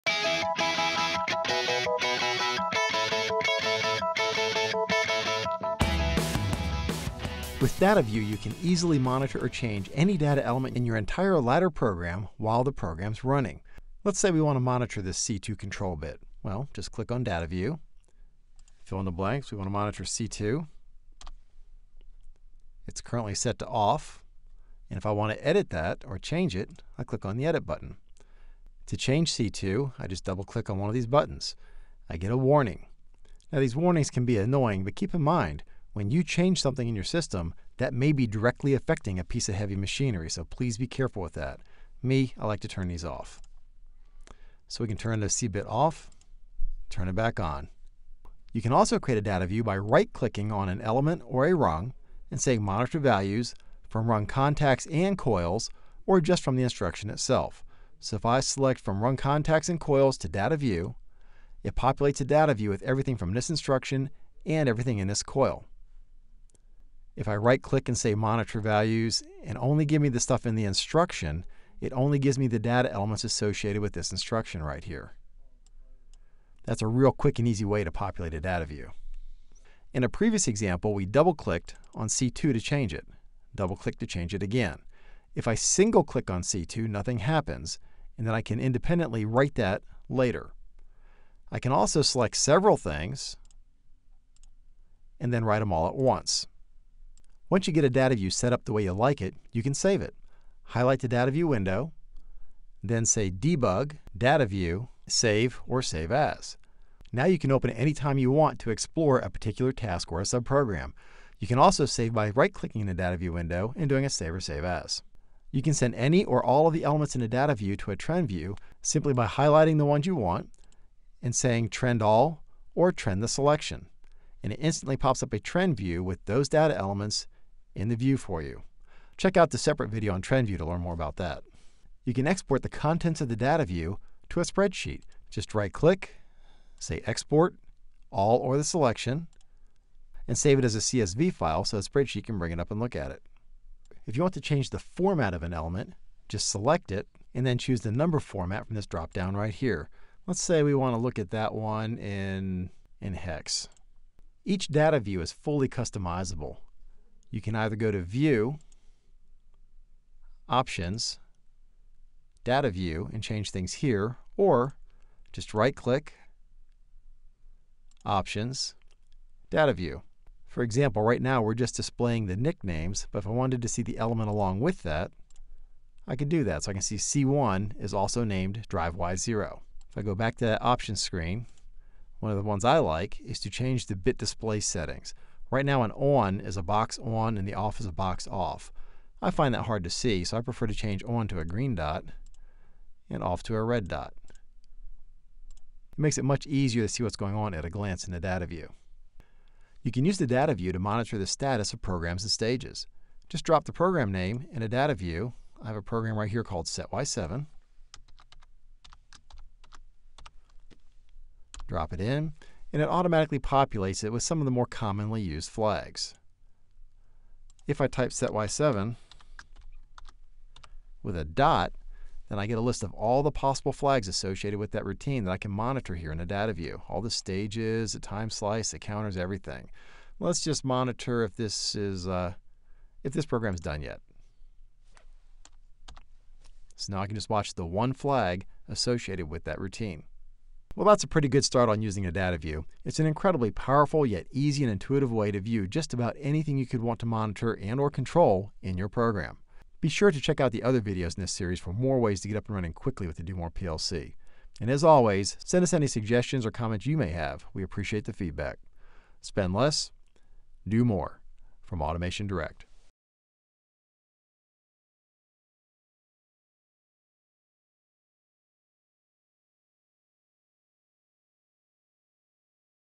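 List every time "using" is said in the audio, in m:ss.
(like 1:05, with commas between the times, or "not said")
4:01.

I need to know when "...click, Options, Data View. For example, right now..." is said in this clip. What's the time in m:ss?
2:45.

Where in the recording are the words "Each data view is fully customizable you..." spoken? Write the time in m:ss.
2:34.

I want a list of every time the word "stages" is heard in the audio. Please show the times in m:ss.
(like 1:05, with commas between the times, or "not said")
3:22, 3:47.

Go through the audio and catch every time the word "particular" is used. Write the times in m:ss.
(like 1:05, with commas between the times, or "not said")
1:49.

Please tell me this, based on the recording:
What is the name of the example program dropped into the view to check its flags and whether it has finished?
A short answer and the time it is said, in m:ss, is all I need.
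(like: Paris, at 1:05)
SetY7, at 3:26.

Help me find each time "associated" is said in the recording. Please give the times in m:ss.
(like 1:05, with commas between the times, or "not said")
1:13, 3:44, 3:58.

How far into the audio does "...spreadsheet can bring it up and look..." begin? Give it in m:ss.
2:21.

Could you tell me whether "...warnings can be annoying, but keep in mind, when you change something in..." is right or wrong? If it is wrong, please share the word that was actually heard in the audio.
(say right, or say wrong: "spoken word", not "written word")
right.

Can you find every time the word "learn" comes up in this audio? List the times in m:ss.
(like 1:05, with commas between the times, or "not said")
2:10.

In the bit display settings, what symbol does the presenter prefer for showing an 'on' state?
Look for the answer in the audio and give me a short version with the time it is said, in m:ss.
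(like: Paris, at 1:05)
green dot, at 3:11.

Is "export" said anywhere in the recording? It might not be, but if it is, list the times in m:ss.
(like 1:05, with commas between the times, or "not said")
2:12, 2:17.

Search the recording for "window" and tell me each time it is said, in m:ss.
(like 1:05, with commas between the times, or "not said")
1:41, 1:53.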